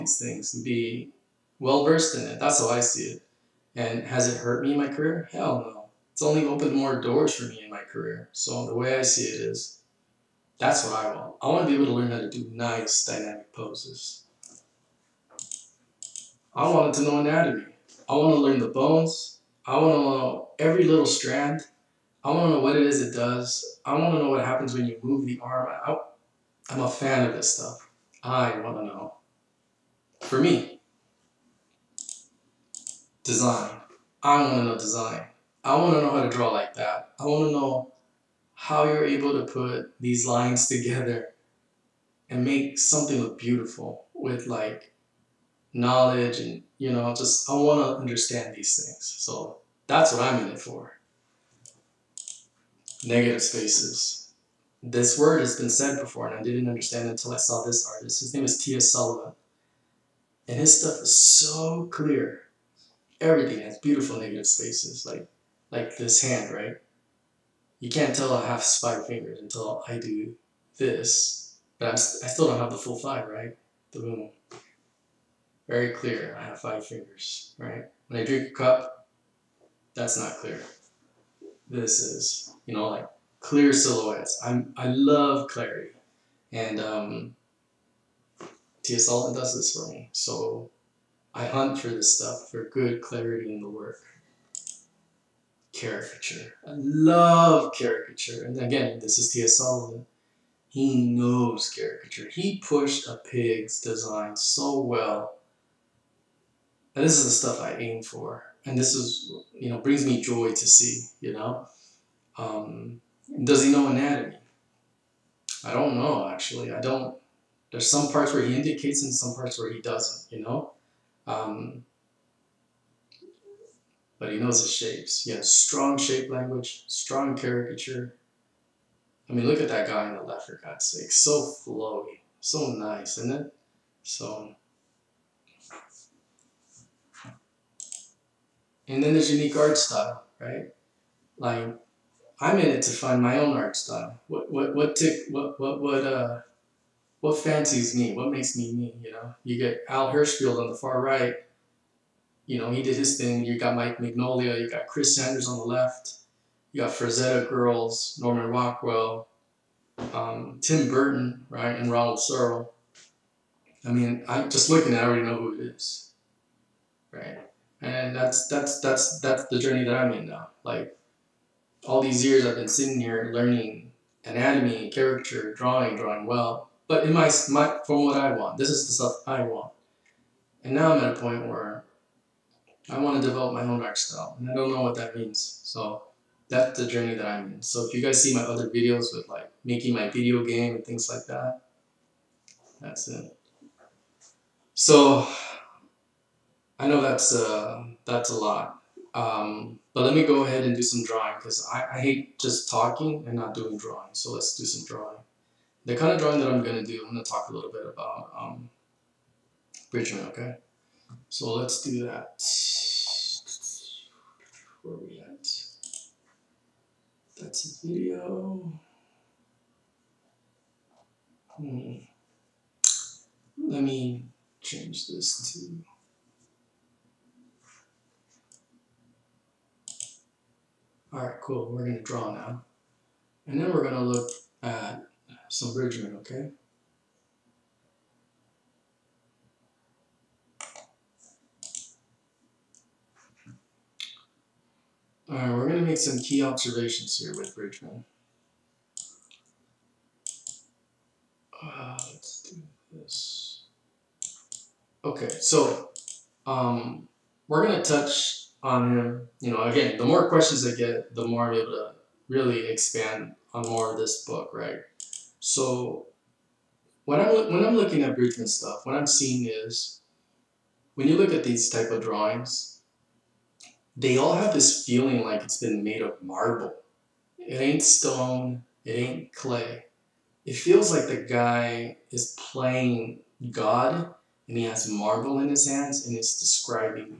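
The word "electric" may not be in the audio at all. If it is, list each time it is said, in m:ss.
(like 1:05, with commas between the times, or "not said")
not said.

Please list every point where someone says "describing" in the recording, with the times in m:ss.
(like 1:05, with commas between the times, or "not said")
4:46.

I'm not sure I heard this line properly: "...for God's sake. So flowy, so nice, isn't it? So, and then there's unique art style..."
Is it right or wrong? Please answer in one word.
right.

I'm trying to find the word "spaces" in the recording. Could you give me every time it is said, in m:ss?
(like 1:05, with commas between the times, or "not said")
0:53, 1:04.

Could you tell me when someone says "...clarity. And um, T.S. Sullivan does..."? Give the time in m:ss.
1:25.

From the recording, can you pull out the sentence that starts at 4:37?
It ain't stone, it ain't clay.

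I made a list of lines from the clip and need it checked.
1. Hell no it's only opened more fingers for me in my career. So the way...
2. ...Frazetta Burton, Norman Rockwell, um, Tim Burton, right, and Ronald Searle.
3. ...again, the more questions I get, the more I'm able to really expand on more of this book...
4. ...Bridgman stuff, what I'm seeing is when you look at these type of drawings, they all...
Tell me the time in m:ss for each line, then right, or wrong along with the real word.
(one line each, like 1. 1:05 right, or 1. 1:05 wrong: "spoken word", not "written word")
1. 0:05 wrong: "doors", not "fingers"
2. 2:36 wrong: "Girls", not "Burton"
3. 4:19 right
4. 4:28 right.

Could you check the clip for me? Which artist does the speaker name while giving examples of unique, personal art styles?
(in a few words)
Al Hirschfeld.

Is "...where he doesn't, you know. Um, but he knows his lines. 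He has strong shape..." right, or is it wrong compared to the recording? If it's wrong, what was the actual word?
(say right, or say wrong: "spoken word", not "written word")
wrong: "shapes", not "lines".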